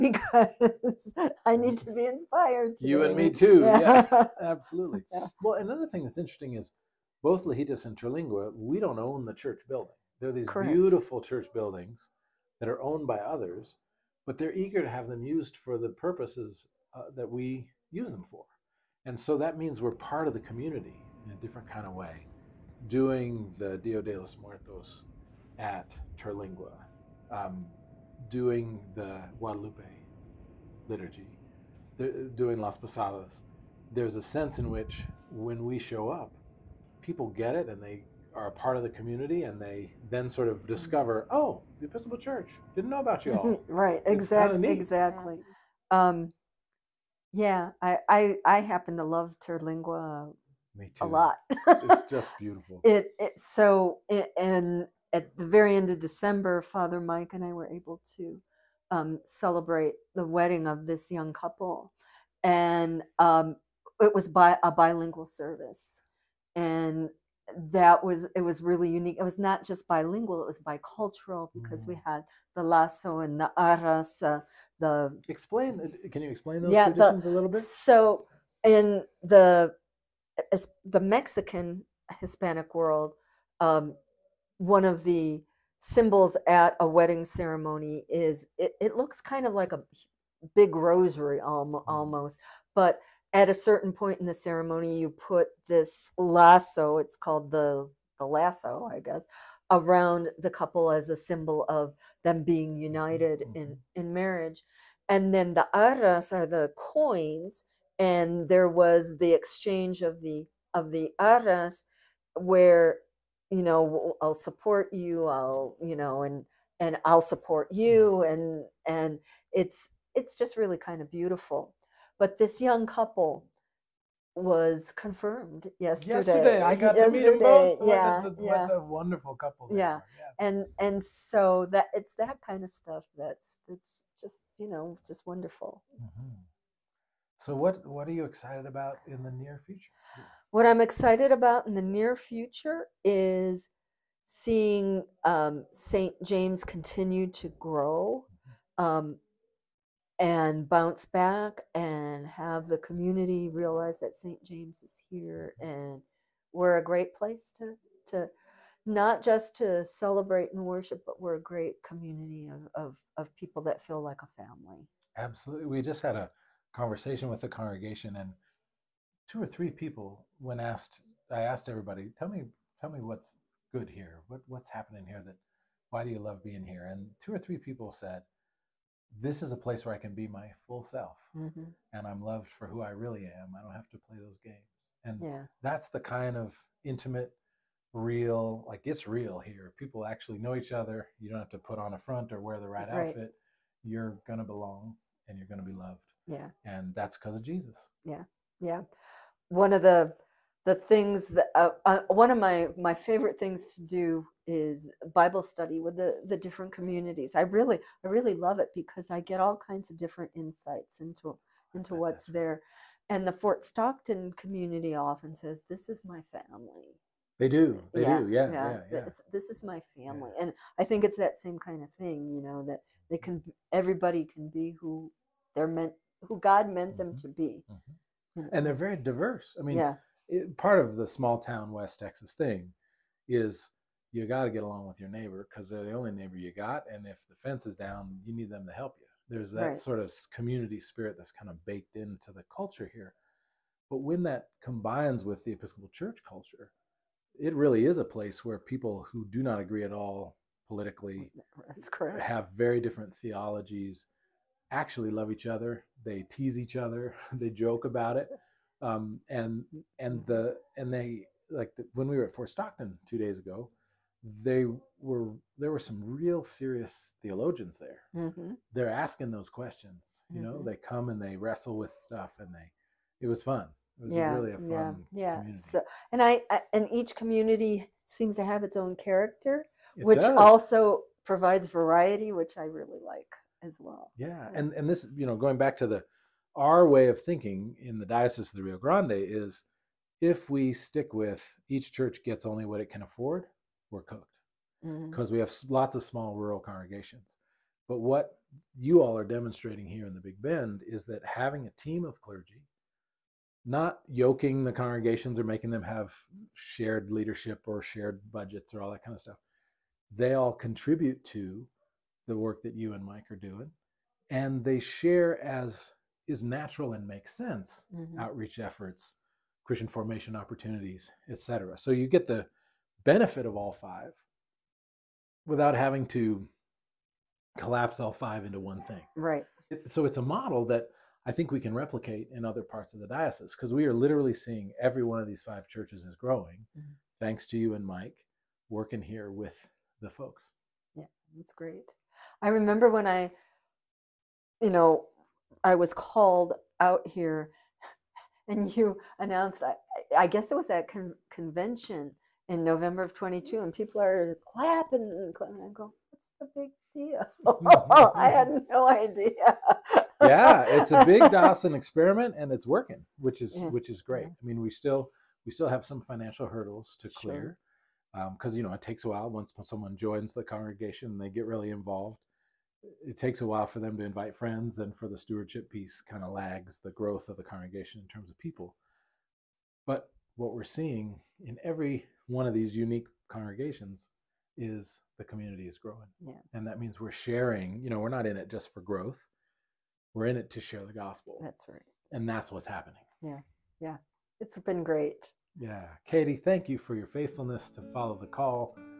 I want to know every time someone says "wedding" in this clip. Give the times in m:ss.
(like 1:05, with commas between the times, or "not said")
1:00, 1:26.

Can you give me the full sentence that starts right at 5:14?
And they share as is natural and makes sense mm-hmm.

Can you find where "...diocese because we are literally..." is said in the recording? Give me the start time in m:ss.
5:33.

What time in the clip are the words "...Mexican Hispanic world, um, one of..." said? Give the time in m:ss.
1:21.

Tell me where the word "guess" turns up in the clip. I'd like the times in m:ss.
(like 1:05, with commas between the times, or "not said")
1:39, 5:50.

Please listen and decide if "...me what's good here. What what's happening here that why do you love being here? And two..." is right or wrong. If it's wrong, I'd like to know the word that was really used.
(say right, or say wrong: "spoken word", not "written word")
right.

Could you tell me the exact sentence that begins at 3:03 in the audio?
I don't have to play those games.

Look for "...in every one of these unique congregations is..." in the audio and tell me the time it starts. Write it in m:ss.
6:21.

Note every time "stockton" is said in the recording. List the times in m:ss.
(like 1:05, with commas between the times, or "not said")
3:33, 4:22.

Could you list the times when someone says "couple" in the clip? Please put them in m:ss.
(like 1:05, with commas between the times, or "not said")
1:01, 1:40, 2:02, 2:09.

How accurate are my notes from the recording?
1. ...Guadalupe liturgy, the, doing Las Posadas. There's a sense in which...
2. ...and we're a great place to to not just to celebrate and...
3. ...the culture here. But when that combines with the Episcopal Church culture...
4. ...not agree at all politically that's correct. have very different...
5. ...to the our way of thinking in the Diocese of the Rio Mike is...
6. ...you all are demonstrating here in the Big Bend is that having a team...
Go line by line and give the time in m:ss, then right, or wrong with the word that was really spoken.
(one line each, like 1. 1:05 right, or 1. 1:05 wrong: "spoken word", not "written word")
1. 0:29 right
2. 2:35 right
3. 4:02 right
4. 4:09 right
5. 4:45 wrong: "Grande", not "Mike"
6. 4:58 right.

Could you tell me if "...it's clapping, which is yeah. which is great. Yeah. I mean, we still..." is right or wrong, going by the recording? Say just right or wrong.
wrong.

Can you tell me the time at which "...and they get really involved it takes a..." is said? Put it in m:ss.
6:11.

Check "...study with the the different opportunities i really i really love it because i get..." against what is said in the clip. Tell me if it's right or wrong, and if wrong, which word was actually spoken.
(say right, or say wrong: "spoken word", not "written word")
wrong: "communities", not "opportunities".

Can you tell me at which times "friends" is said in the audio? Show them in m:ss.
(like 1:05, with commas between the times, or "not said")
6:14.